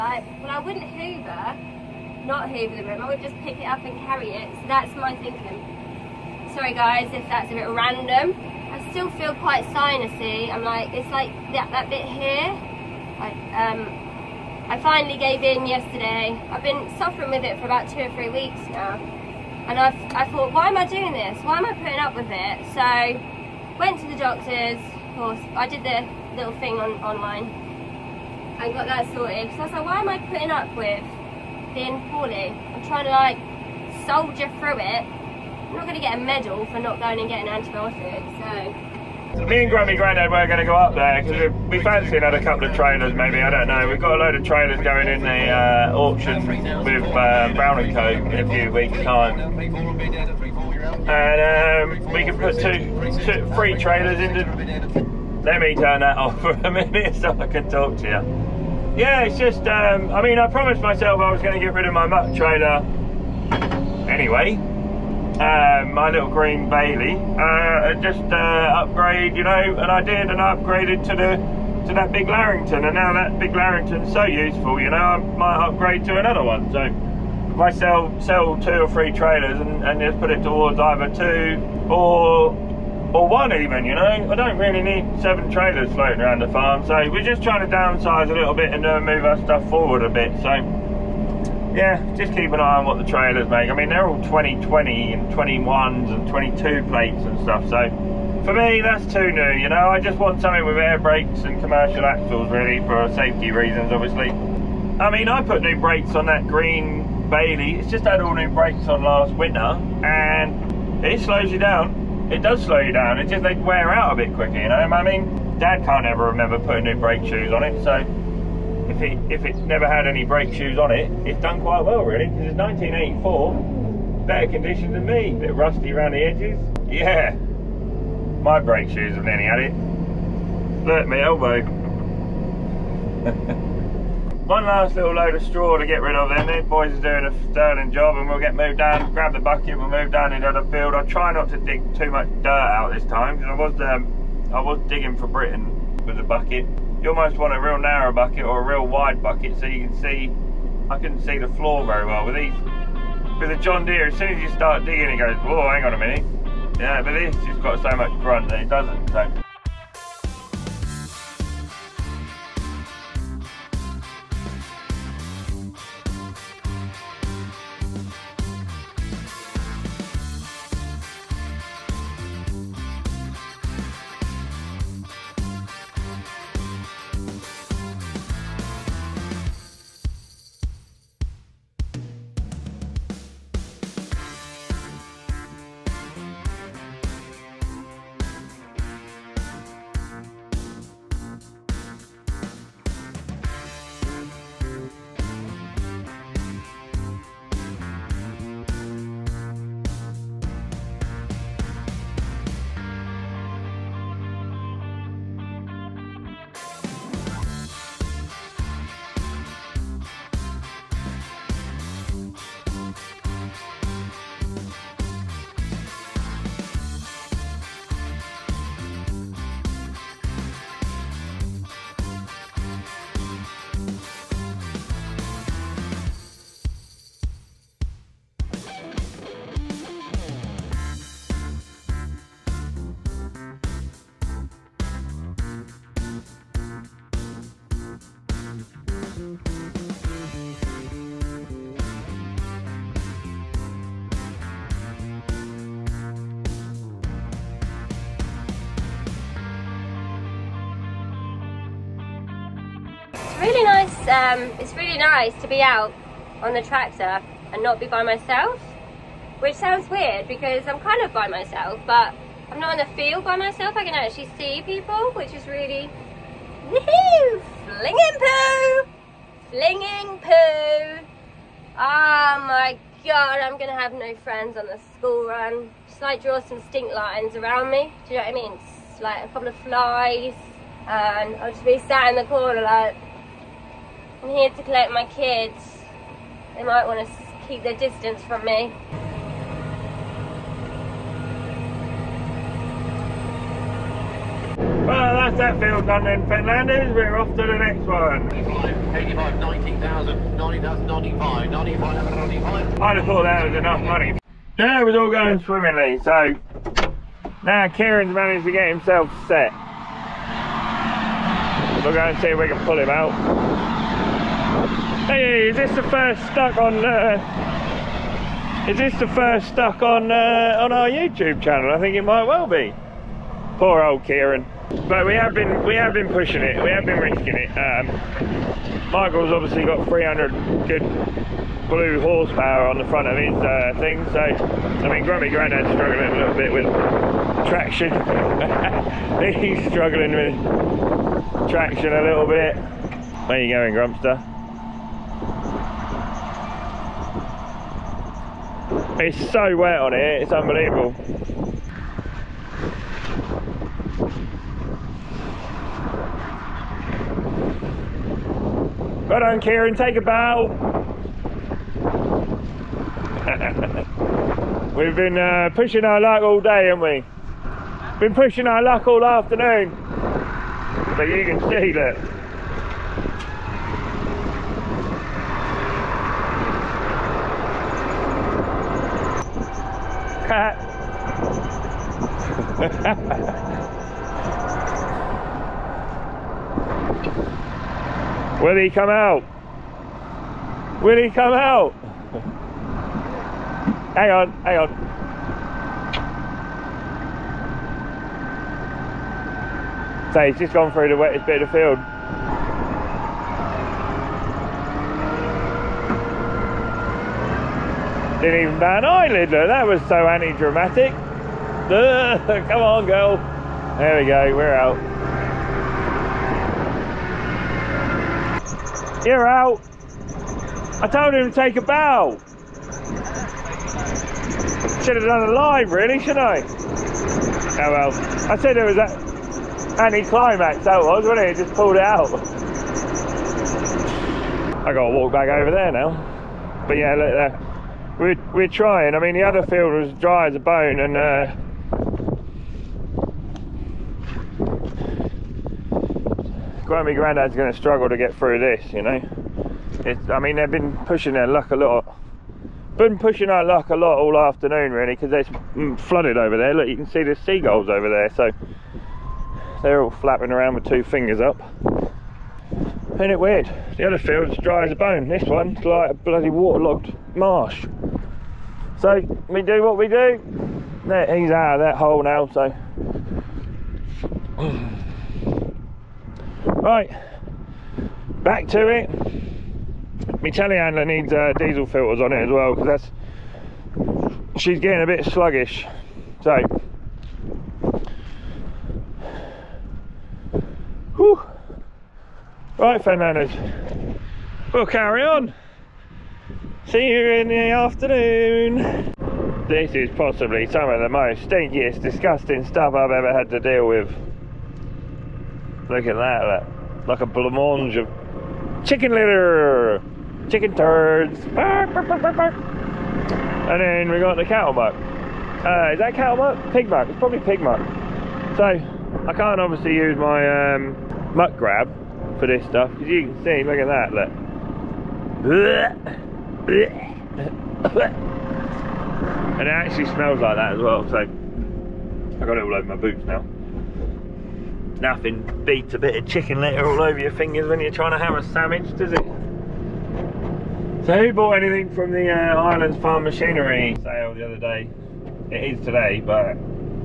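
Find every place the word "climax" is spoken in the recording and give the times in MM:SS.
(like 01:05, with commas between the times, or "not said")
07:09.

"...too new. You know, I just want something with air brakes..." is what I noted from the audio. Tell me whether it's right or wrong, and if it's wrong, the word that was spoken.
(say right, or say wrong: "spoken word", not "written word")
right.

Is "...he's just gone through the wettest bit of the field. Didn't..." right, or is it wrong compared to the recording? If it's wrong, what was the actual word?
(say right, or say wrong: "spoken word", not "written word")
right.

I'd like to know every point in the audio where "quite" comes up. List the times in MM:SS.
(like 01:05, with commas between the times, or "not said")
00:09, 02:01.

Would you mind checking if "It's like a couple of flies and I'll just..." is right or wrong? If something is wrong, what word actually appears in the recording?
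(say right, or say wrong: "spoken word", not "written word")
right.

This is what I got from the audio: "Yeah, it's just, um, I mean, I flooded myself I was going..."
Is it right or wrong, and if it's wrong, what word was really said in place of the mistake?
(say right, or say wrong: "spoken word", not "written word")
wrong: "promised", not "flooded".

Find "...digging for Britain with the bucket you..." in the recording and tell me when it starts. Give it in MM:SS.
02:24.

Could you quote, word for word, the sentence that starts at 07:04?
Should have done a line, really, shouldn't I?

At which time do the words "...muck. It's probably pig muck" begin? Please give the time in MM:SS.
08:36.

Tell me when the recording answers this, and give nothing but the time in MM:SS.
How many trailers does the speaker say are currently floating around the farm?
01:25.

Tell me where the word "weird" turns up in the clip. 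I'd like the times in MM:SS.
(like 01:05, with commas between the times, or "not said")
04:19, 07:43.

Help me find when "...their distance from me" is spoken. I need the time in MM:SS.
04:47.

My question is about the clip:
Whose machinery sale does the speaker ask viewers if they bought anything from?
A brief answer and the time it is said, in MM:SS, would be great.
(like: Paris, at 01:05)
Islands Farm Machinery, at 09:02.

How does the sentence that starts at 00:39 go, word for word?
Me and Grumpy Grandad were going to go up there because we fancy another couple of trailers maybe, I don't know.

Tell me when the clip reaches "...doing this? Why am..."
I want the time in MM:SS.
00:20.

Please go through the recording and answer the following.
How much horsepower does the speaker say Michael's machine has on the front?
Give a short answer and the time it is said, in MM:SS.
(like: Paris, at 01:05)
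300, at 05:29.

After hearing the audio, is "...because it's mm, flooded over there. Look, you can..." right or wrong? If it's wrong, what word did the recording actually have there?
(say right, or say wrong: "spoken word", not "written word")
right.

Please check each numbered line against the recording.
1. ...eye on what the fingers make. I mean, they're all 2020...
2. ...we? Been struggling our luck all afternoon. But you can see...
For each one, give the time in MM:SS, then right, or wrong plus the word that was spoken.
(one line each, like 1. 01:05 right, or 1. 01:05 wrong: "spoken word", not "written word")
1. 01:32 wrong: "trailers", not "fingers"
2. 06:06 wrong: "pushing", not "struggling".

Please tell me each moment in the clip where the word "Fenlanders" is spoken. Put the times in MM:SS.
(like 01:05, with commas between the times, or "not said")
04:56, 08:12.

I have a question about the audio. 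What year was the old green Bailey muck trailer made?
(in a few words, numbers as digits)
1984.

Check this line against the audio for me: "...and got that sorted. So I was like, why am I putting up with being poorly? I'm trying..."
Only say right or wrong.
right.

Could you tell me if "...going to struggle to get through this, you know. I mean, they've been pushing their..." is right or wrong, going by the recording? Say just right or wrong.
right.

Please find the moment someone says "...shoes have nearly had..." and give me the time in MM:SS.
02:08.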